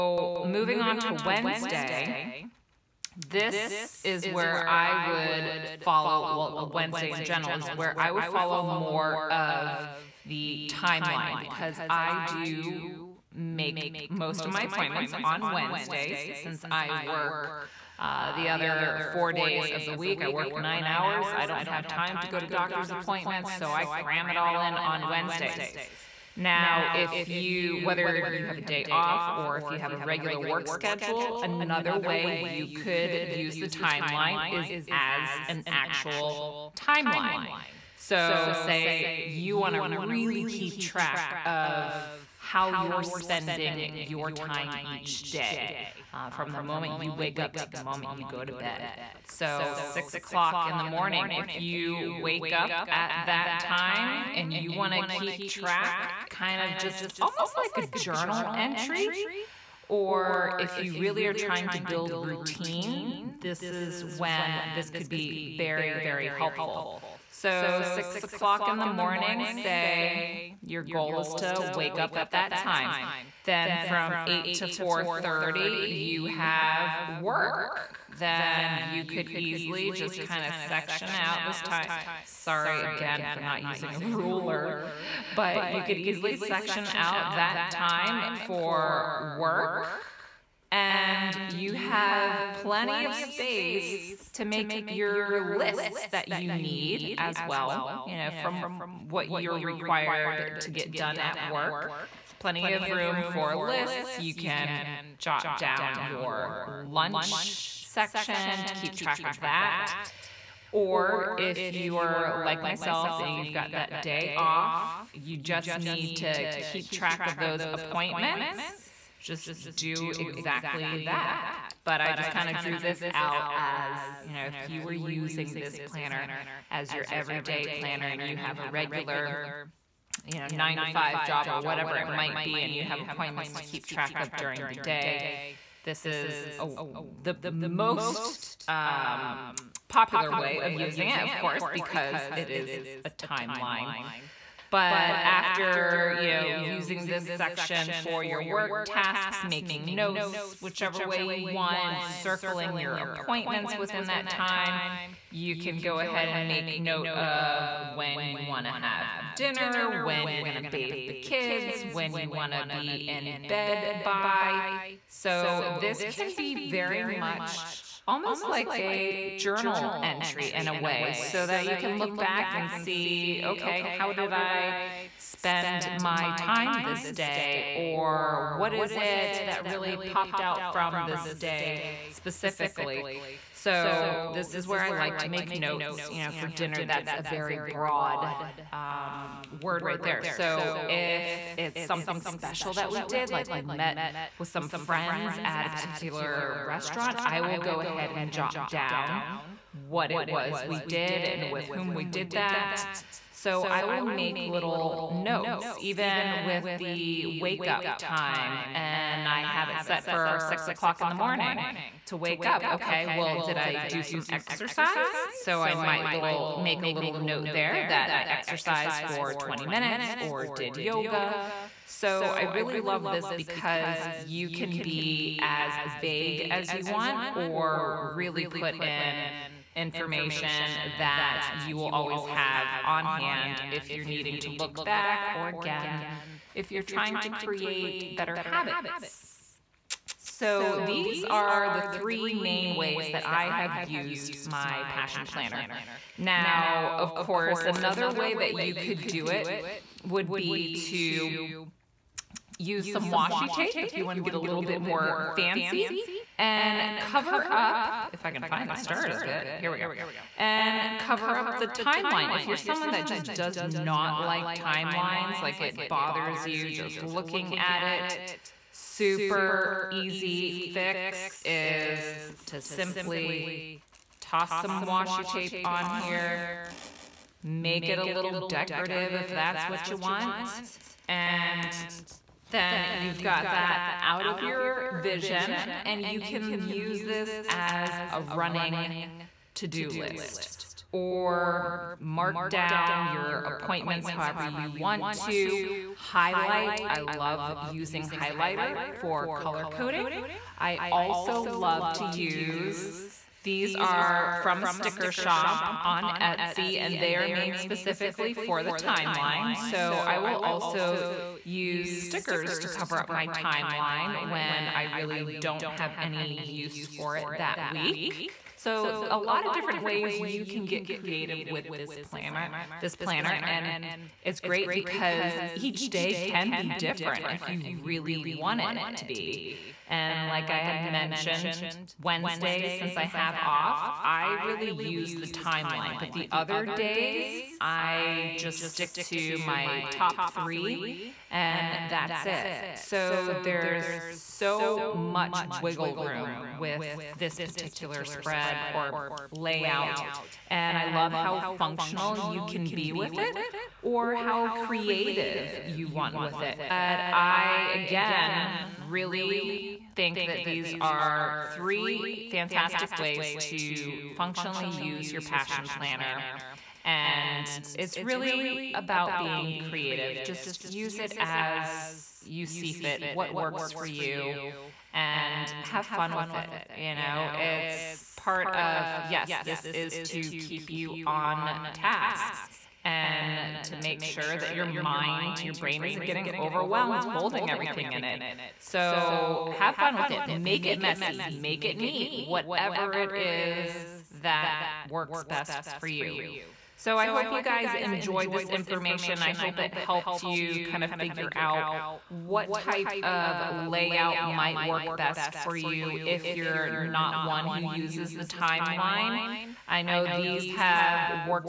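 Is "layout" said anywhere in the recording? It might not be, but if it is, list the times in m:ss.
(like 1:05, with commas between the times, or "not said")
5:49, 6:43.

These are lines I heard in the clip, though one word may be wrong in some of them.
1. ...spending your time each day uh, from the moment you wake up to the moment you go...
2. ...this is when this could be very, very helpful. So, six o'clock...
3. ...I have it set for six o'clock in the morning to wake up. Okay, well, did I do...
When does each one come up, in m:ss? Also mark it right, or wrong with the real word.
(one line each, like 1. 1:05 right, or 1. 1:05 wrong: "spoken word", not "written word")
1. 0:43 right
2. 1:03 right
3. 3:29 right.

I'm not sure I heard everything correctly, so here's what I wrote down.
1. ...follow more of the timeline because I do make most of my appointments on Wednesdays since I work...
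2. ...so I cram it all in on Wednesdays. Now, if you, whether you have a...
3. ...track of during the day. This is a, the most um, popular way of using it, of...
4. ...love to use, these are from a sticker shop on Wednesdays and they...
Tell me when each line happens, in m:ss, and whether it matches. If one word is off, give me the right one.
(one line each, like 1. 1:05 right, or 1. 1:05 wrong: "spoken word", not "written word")
1. 0:08 right
2. 0:23 right
3. 2:13 right
4. 5:01 wrong: "Etsy", not "Wednesdays".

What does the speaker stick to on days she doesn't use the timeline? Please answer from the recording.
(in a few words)
top three.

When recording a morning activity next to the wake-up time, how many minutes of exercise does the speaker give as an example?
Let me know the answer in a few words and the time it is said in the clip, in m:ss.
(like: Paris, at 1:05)
20, at 3:39.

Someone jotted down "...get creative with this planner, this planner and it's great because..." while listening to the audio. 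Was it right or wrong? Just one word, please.
right.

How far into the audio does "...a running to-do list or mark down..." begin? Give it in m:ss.
4:48.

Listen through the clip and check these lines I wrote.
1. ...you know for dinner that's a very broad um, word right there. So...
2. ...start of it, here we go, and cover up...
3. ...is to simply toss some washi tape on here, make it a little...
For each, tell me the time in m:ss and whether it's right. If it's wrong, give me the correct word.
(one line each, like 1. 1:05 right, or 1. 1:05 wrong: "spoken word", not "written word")
1. 3:06 right
2. 4:18 right
3. 4:31 right.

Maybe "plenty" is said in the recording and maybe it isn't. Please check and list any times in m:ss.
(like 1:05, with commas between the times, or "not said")
1:32, 1:42.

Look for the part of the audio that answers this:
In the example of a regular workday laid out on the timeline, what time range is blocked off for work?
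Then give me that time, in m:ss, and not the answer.
1:14.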